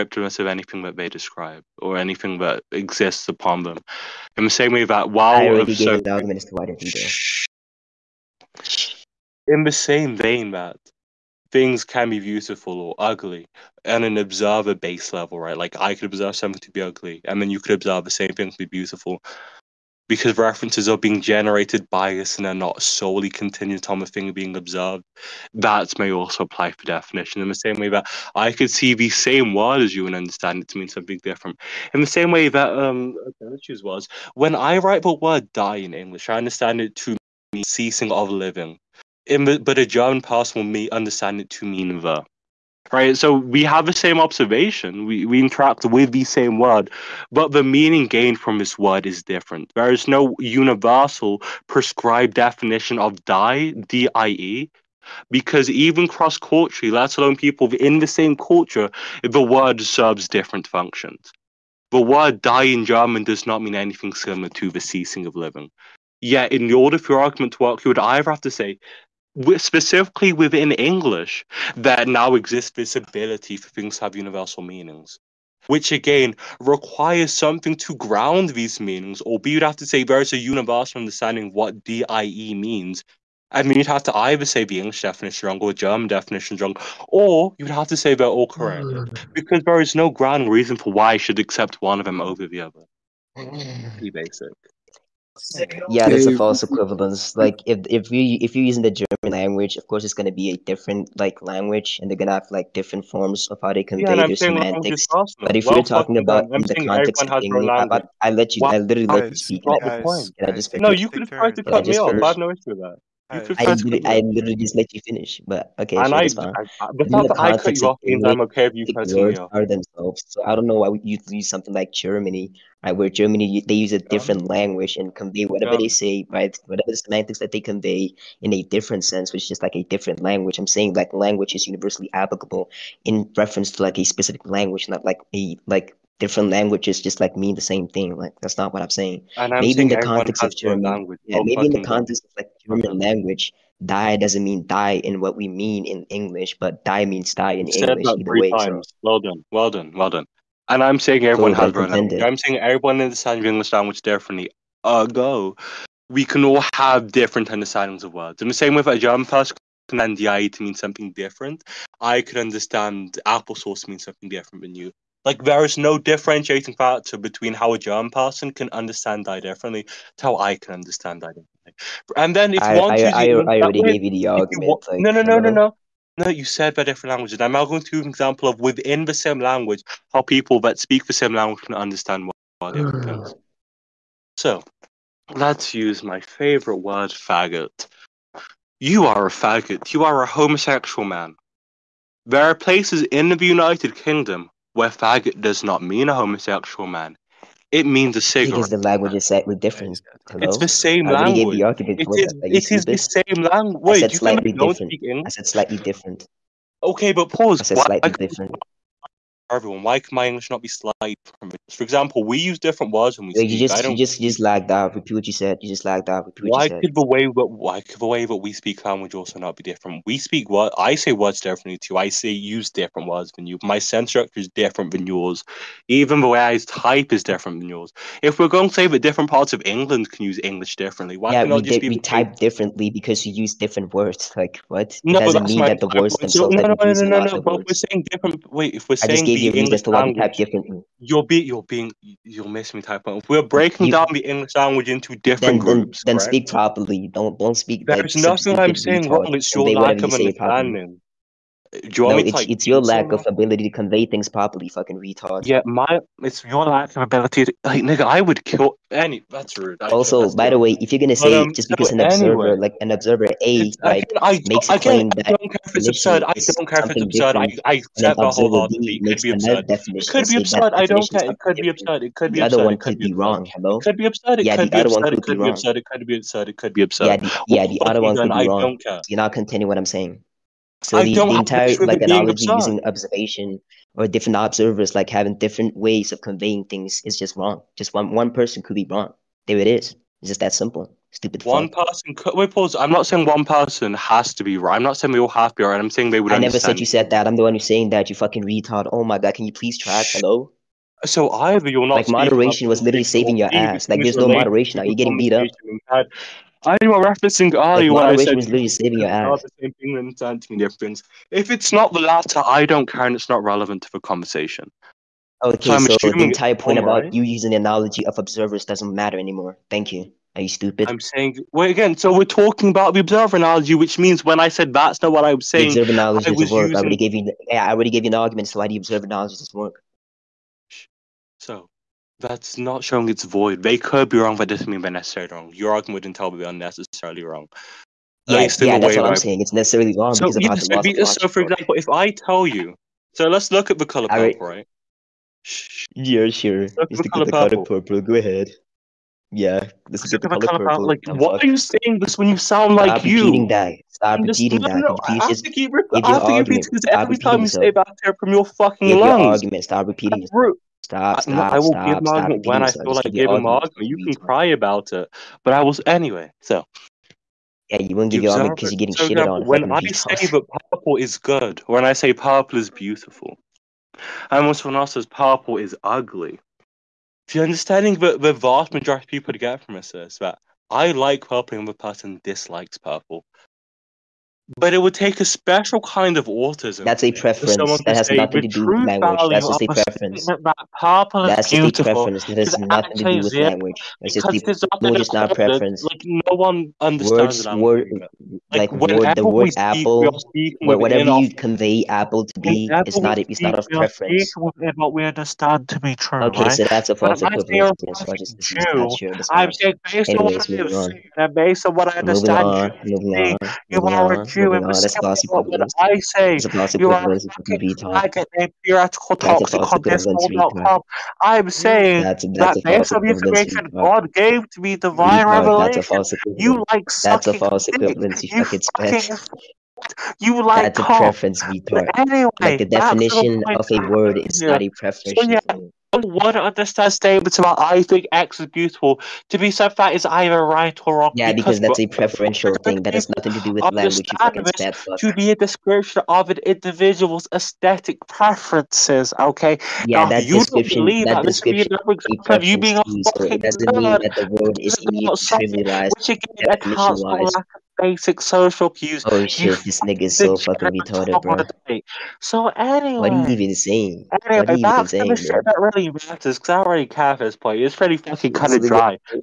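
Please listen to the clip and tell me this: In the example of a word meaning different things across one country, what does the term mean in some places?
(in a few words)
a cigarette.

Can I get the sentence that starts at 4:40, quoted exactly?
So the, the, entire like analogy using observation or different observers like having different ways of conveying things is just wrong.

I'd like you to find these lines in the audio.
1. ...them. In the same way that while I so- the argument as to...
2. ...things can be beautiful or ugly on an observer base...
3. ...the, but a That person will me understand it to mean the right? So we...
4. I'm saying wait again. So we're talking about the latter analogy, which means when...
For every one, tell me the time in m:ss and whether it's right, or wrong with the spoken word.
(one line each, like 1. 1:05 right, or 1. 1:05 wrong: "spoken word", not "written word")
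1. 0:03 right
2. 0:11 right
3. 0:39 wrong: "German", not "That"
4. 5:20 wrong: "observer", not "latter".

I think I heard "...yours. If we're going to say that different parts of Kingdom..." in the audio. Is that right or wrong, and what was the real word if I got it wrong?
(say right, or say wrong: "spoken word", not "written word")
wrong: "England", not "Kingdom".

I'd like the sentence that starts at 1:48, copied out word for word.
I literally guys, let you speak.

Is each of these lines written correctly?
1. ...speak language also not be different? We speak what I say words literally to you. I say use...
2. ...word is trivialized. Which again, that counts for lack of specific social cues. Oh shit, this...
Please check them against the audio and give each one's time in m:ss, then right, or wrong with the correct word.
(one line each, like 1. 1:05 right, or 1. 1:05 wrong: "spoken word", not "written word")
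1. 3:38 wrong: "differently", not "literally"
2. 7:34 wrong: "basic", not "specific".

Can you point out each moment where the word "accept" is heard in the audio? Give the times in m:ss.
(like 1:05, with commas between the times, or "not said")
1:31, 4:27.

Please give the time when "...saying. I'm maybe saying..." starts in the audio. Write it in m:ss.
2:18.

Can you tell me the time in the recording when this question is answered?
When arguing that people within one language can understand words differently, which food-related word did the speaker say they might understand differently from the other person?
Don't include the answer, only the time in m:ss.
2:43.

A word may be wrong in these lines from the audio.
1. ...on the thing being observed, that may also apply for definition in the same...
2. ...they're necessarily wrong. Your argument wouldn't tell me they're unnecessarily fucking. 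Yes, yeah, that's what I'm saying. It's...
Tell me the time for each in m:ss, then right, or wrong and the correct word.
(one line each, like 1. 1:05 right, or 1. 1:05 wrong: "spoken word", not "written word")
1. 0:23 right
2. 5:34 wrong: "wrong", not "fucking".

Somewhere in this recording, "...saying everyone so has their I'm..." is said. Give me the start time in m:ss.
2:31.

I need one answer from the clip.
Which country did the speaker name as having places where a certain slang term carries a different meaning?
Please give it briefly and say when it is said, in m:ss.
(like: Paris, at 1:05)
United Kingdom, at 3:13.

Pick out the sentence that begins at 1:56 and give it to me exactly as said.
I, the fact that I cut you off means I'm okay with you cutting me off.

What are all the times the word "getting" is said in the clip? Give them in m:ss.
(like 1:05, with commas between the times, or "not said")
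5:04, 6:08.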